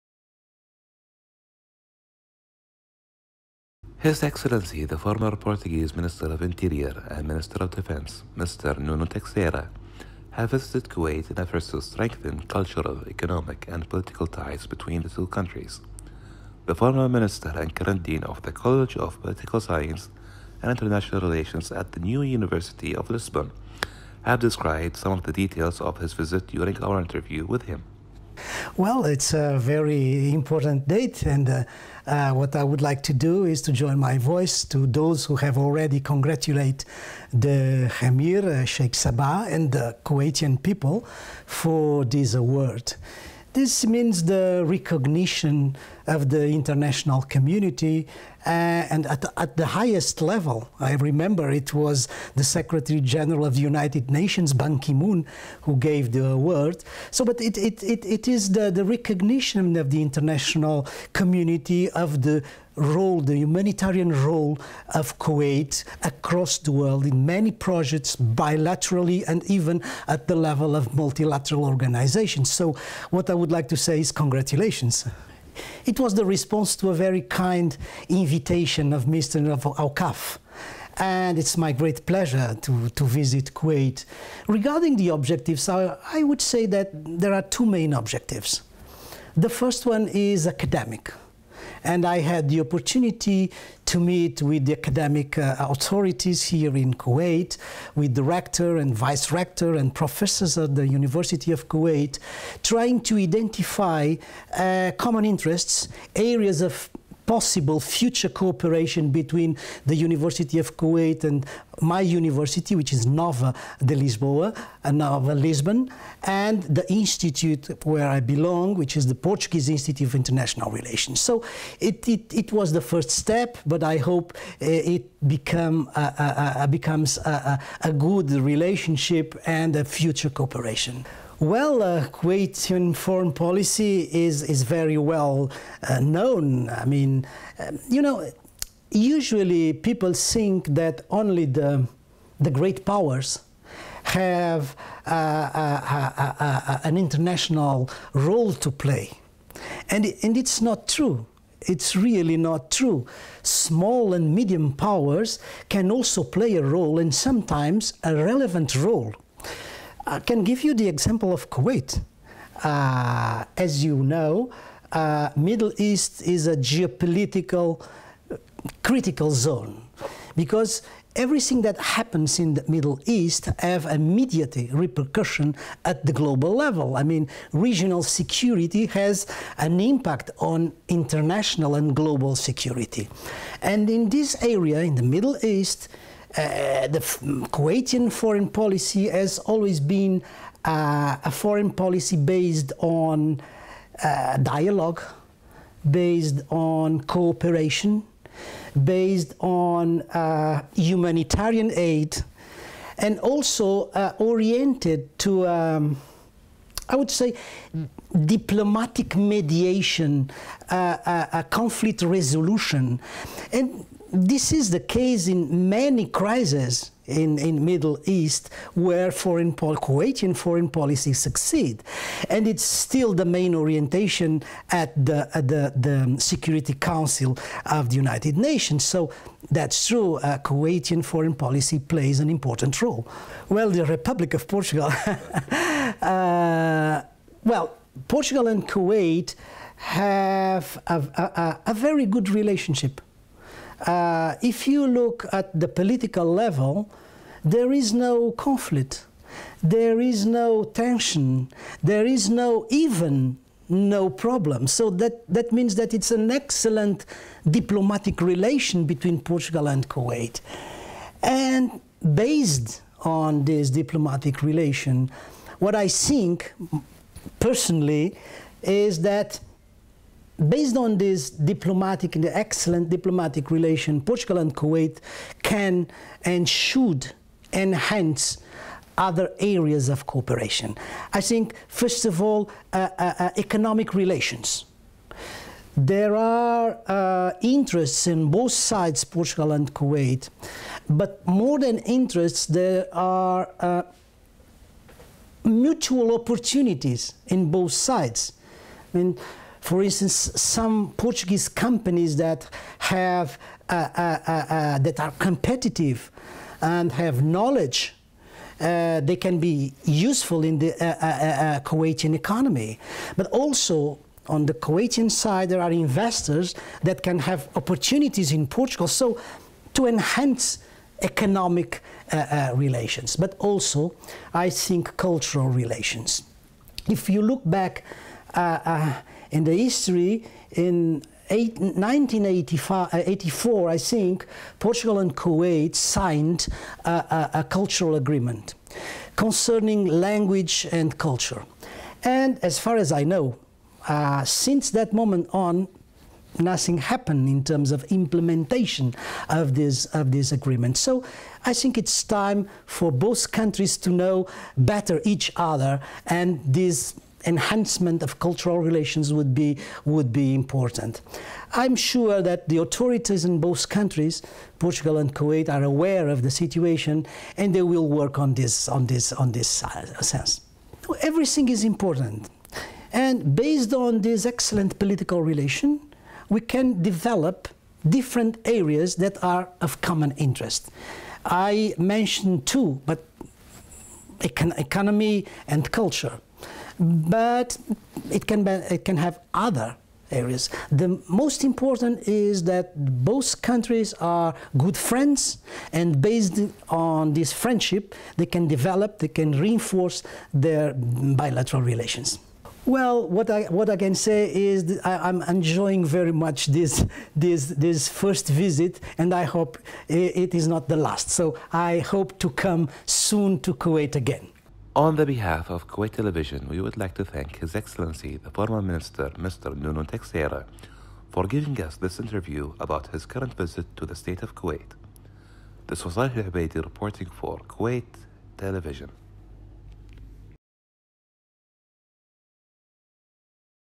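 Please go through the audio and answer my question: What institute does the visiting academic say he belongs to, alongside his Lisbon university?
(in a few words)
Portuguese Institute of International Relations.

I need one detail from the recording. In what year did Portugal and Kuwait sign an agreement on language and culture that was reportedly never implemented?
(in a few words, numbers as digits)
1984.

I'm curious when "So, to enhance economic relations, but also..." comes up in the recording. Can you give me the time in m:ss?
5:18.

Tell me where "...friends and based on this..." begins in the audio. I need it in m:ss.
6:34.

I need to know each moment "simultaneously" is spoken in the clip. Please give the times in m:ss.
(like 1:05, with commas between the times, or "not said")
not said.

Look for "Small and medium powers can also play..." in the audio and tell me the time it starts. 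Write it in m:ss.
2:33.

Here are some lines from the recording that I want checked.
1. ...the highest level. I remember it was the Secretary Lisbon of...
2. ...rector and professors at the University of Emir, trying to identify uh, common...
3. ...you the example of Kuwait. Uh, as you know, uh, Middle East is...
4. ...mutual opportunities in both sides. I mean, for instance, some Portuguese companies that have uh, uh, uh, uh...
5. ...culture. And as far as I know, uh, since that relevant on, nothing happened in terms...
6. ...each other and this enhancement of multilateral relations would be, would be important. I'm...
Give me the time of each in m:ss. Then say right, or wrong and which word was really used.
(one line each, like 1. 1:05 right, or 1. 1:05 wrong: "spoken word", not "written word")
1. 0:49 wrong: "General", not "Lisbon"
2. 1:39 wrong: "Kuwait", not "Emir"
3. 2:40 right
4. 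4:55 right
5. 5:40 wrong: "moment", not "relevant"
6. 5:55 wrong: "cultural", not "multilateral".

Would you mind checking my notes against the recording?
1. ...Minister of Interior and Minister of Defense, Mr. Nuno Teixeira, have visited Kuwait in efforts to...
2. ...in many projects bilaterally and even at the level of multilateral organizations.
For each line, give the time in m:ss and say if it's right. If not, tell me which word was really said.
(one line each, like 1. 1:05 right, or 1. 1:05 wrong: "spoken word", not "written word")
1. 0:05 right
2. 1:07 right.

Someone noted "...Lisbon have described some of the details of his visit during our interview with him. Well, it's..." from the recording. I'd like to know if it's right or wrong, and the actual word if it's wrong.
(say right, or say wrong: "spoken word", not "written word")
right.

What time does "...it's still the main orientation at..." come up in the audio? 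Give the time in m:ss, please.
3:42.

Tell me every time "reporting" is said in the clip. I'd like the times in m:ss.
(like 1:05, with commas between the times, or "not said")
7:06.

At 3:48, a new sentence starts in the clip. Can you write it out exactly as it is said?
So that's true, uh, Kuwaitian foreign policy plays an important role.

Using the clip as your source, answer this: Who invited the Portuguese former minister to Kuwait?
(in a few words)
Mr. Al-Kaf.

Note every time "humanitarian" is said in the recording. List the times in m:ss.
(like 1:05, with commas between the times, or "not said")
1:03, 3:20.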